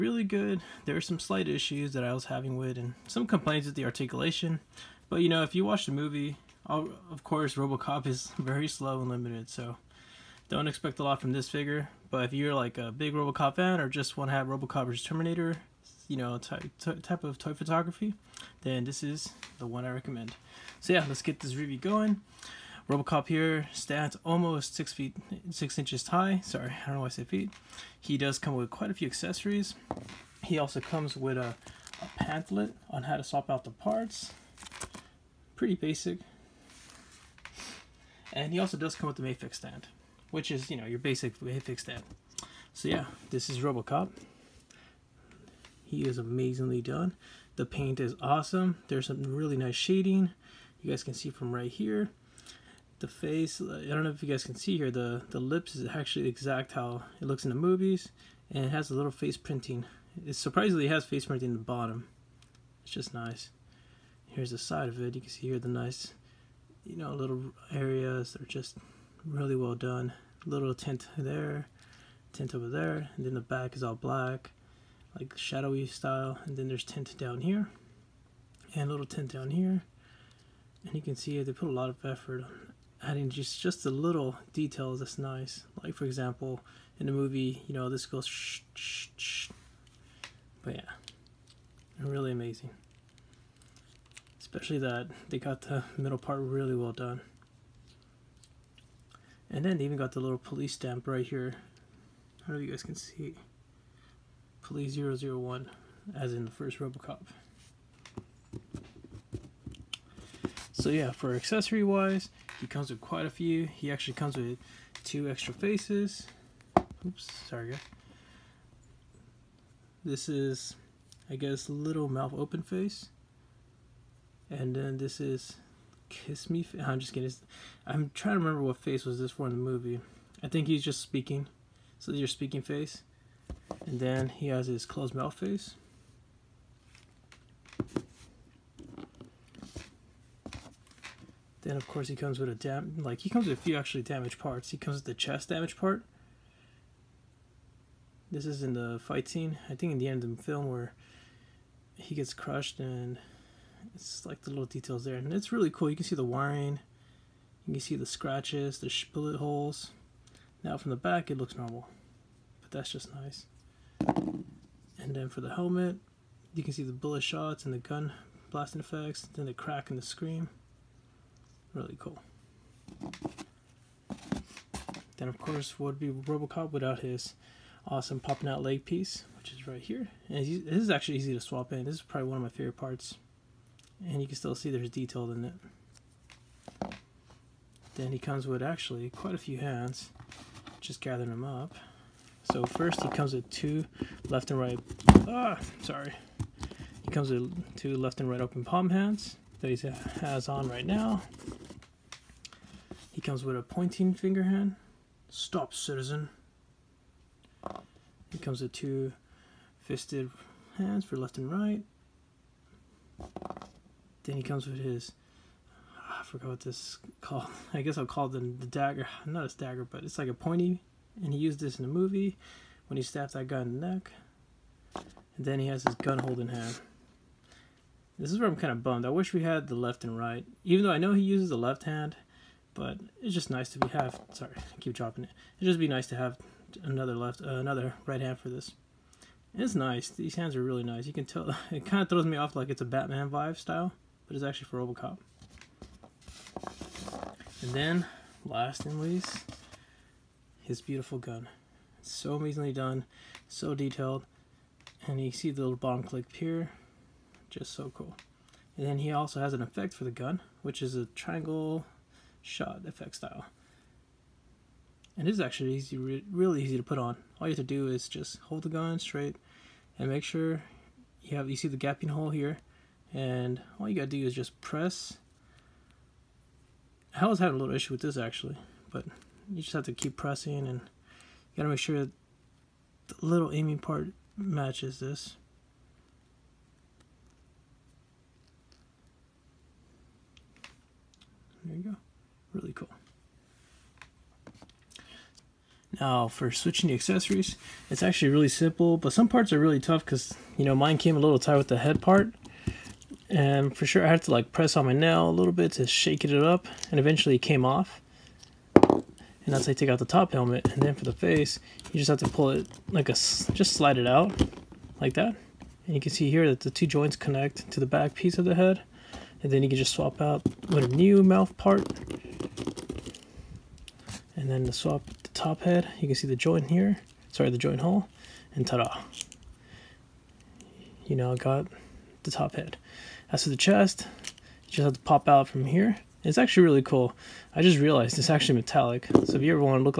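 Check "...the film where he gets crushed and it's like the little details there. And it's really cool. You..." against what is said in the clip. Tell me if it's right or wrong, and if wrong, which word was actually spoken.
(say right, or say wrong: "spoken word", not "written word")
right.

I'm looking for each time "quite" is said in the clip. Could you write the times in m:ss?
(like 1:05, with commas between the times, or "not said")
0:28, 1:52, 3:09.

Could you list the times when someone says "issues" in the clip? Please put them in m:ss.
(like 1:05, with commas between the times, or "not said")
0:01, 4:37.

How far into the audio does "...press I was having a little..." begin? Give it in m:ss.
4:34.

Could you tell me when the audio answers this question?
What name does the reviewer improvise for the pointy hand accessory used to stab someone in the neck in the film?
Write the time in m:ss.
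3:38.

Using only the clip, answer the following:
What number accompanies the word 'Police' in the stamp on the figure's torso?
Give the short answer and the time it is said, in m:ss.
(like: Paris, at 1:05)
001, at 1:44.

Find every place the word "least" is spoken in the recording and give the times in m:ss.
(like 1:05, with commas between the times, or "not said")
4:08.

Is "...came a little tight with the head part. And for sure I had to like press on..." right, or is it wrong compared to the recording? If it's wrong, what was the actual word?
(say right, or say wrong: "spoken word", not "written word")
right.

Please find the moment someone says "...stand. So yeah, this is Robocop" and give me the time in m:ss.
0:41.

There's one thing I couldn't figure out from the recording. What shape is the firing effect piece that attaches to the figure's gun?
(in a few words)
triangle.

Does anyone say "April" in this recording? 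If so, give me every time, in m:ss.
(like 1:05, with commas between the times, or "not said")
not said.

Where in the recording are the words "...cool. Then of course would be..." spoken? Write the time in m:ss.
2:51.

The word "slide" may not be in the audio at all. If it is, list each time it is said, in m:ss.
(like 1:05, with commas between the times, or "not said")
5:13.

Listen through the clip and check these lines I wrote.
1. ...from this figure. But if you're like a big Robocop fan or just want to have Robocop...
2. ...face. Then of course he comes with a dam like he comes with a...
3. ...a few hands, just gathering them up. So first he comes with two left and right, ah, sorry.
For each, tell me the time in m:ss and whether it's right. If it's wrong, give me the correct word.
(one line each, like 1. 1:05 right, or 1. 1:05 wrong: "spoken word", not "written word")
1. 0:11 right
2. 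2:15 right
3. 3:09 right.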